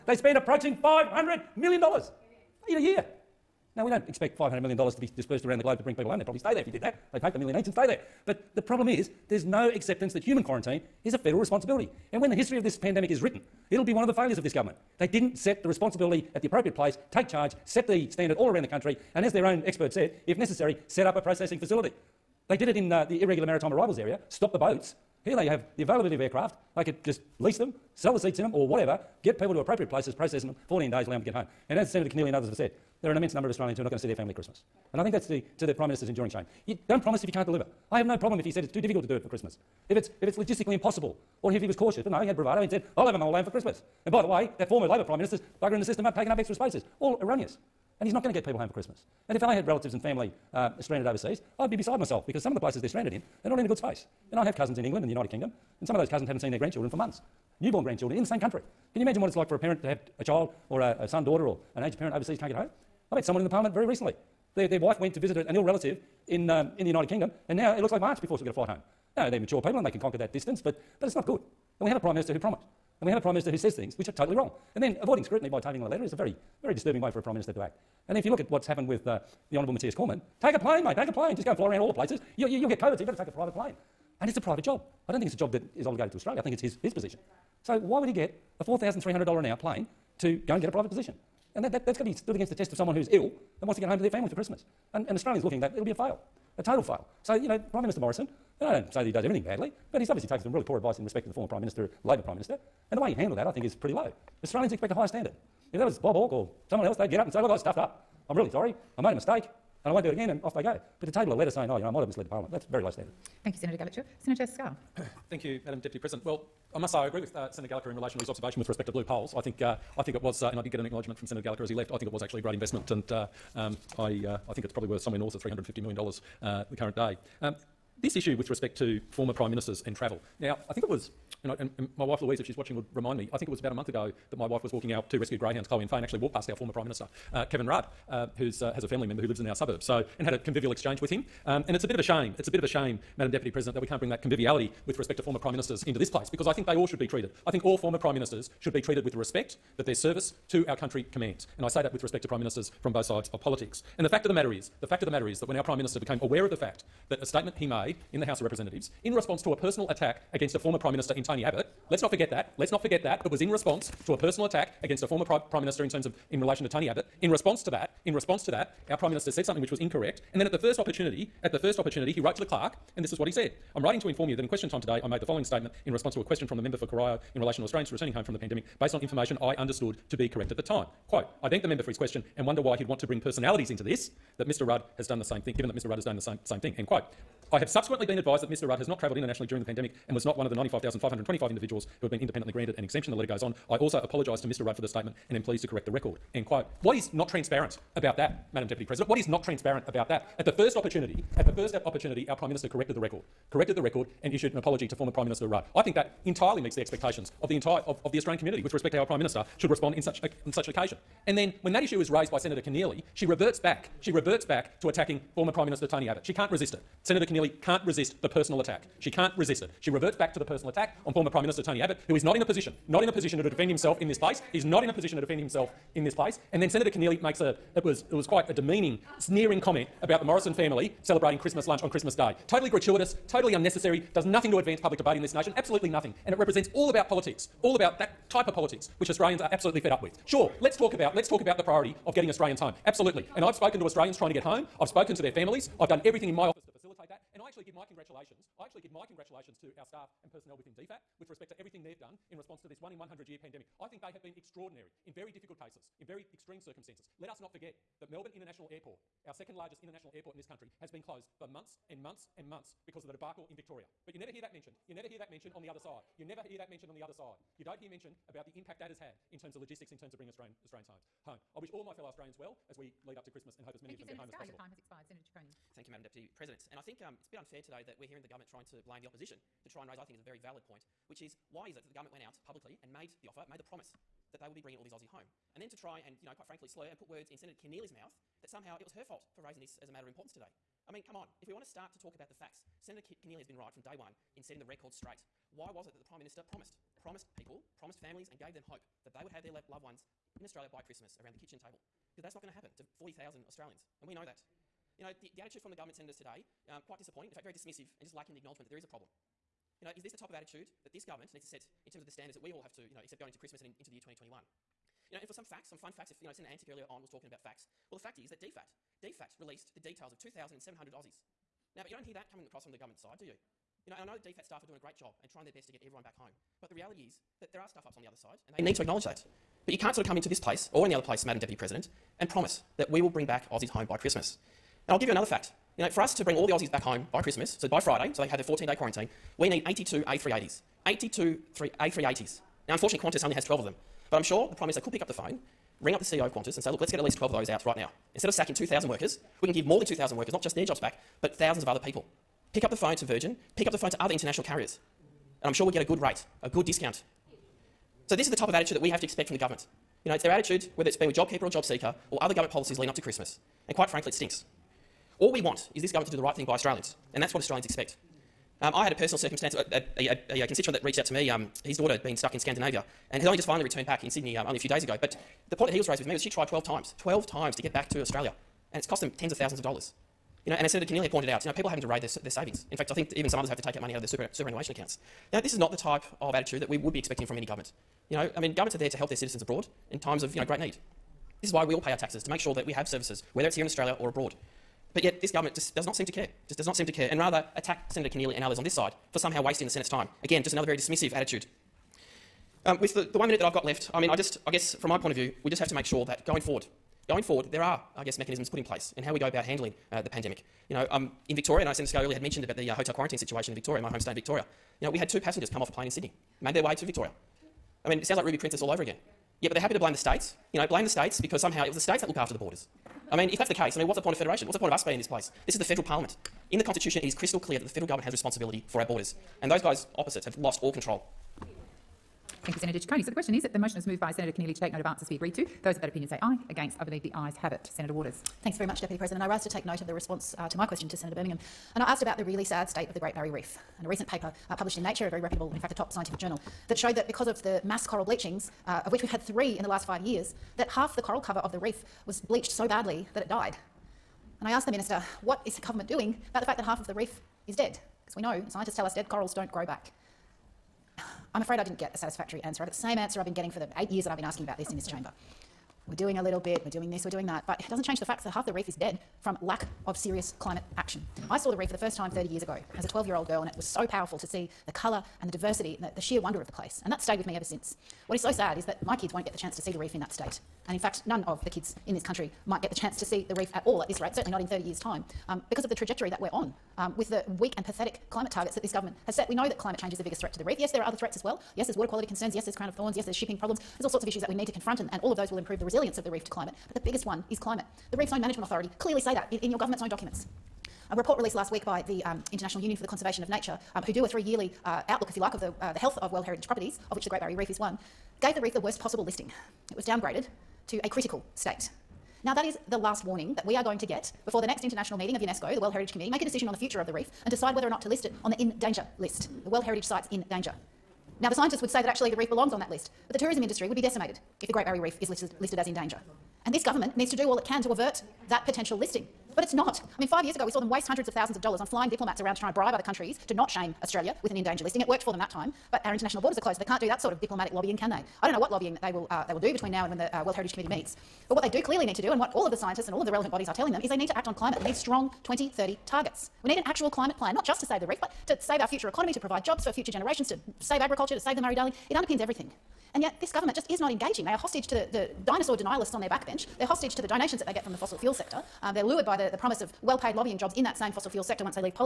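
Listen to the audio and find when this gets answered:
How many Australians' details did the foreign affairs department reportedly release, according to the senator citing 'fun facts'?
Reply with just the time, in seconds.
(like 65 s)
320 s.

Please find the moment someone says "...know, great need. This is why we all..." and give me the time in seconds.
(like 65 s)
390 s.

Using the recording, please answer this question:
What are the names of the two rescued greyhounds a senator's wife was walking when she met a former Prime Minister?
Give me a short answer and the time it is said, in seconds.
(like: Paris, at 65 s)
Chloe and Faye, at 135 s.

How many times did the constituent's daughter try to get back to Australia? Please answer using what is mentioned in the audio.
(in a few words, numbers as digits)
12.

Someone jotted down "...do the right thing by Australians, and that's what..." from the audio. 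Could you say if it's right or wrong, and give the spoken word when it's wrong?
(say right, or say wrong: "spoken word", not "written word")
right.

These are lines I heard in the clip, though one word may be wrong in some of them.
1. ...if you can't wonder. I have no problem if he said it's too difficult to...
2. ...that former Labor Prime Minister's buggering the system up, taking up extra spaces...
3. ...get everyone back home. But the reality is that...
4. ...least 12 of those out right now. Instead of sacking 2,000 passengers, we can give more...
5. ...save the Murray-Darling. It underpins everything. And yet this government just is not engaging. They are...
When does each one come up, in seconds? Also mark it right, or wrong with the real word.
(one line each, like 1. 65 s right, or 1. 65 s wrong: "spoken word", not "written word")
1. 37 s wrong: "deliver", not "wonder"
2. 44 s right
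3. 325 s right
4. 347 s wrong: "workers", not "passengers"
5. 551 s right.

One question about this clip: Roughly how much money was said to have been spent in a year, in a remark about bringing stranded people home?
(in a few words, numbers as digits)
$500 million.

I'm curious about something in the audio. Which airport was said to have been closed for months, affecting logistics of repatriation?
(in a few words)
Melbourne International Airport.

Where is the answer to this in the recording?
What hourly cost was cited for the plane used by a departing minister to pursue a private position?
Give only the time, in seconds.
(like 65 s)
88 s.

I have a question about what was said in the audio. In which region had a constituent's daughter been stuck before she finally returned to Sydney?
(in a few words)
Scandinavia.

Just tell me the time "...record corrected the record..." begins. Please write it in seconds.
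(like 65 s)
202 s.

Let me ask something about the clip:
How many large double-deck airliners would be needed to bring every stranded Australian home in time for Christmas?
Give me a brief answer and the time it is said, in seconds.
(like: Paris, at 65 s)
82, at 339 s.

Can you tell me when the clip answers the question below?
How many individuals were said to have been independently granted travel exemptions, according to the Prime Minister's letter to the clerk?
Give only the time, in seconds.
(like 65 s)
190 s.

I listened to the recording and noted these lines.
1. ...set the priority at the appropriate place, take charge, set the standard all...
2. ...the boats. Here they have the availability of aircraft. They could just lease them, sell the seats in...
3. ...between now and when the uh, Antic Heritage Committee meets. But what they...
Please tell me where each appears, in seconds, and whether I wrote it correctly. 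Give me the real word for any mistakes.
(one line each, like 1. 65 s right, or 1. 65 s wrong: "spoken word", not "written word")
1. 15 s wrong: "responsibility", not "priority"
2. 24 s right
3. 539 s wrong: "World", not "Antic".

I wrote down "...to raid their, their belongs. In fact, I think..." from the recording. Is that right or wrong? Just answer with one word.
wrong.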